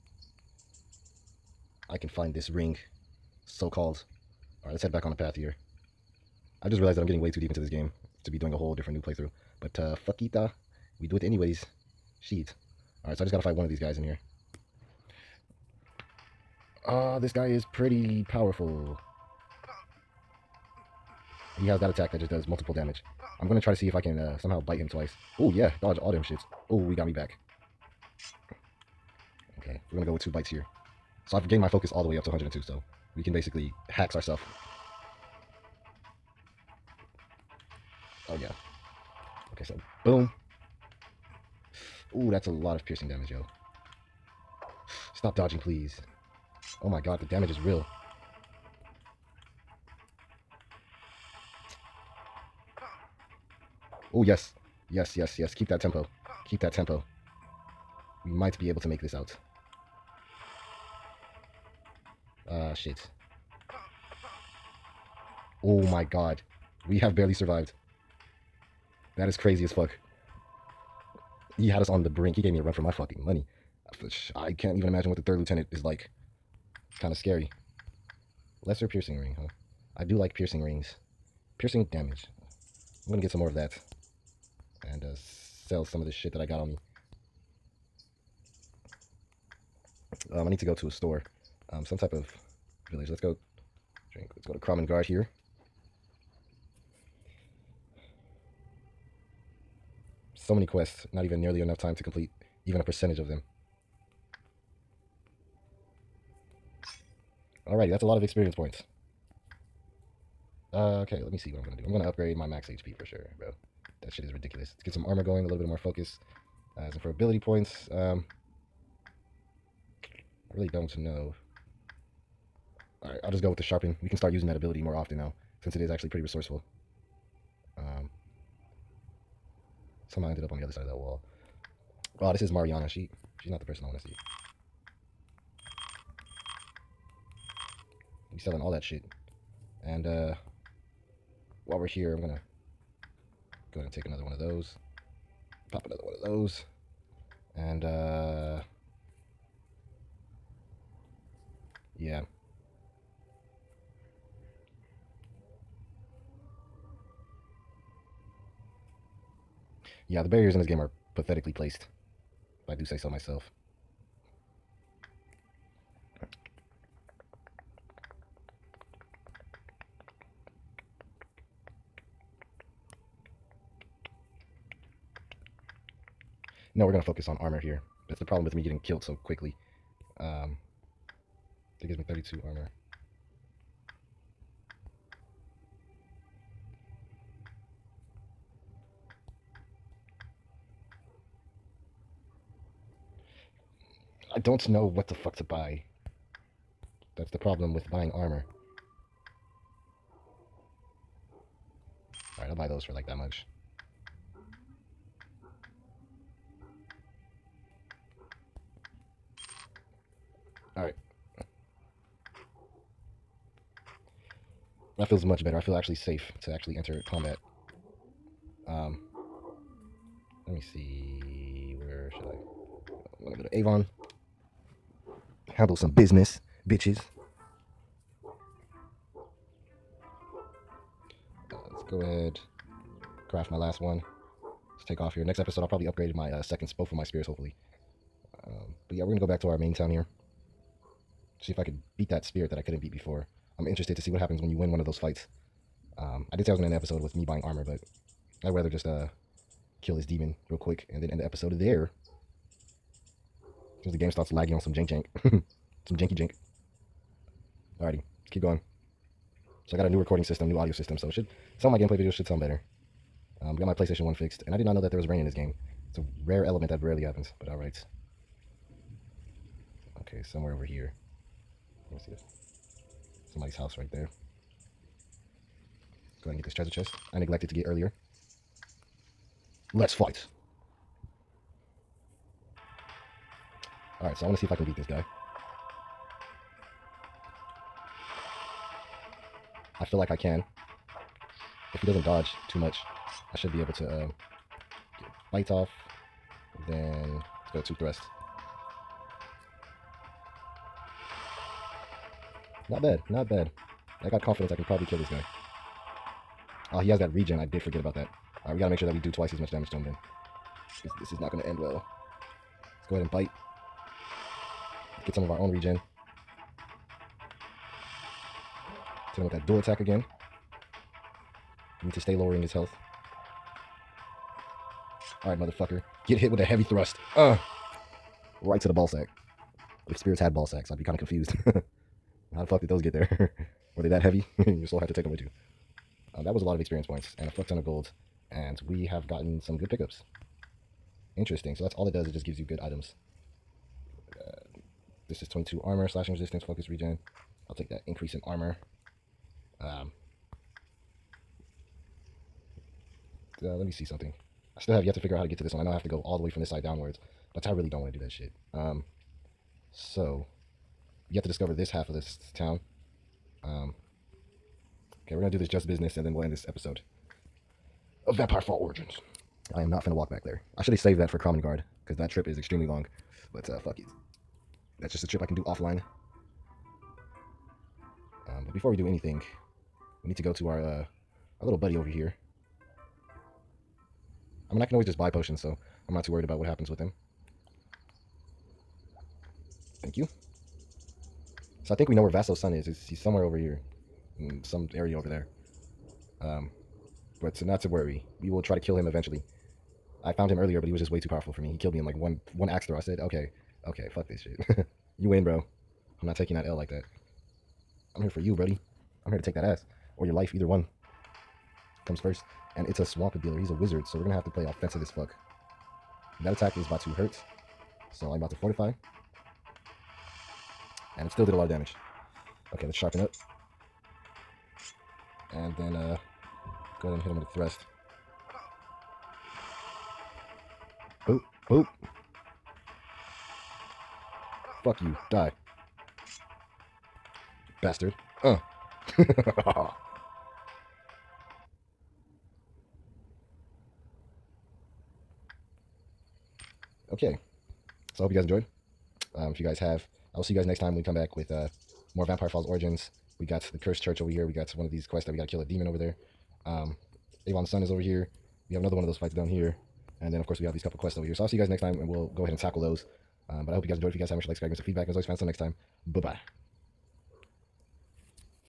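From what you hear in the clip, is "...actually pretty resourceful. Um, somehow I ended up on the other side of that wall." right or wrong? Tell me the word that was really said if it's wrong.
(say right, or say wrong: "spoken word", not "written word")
right.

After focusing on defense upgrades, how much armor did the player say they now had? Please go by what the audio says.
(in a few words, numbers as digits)
32.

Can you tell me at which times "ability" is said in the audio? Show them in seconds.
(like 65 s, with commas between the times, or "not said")
117 s, 124 s.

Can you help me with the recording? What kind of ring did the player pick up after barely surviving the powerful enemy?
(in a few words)
Lesser piercing ring.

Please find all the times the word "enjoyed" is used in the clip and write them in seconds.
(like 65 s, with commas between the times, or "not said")
448 s, 463 s.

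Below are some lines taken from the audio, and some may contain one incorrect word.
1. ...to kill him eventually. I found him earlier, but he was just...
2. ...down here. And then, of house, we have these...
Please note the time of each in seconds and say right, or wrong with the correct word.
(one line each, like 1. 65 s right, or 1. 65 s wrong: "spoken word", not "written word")
1. 398 s right
2. 459 s wrong: "course", not "house".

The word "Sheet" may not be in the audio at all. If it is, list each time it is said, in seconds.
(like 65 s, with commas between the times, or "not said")
12 s.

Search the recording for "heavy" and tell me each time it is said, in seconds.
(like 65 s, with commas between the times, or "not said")
326 s, 334 s.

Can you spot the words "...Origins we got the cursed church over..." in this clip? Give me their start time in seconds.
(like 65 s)
452 s.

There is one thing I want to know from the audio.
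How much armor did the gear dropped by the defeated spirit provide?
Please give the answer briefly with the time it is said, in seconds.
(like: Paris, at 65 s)
22, at 345 s.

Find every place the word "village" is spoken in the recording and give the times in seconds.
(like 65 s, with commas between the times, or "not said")
92 s.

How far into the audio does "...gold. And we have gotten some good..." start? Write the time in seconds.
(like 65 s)
337 s.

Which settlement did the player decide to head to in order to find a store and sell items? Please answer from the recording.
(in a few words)
Kramen Guard.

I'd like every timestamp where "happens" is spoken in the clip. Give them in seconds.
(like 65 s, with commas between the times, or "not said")
244 s, 267 s, 386 s.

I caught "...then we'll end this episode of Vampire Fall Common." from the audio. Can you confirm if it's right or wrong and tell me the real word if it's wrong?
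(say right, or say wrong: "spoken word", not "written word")
wrong: "Origins", not "Common".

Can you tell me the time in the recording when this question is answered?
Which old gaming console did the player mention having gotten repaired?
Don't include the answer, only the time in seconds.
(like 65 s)
263 s.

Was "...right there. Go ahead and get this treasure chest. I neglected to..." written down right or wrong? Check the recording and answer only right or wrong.
right.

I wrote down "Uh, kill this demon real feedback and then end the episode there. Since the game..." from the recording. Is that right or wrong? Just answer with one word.
wrong.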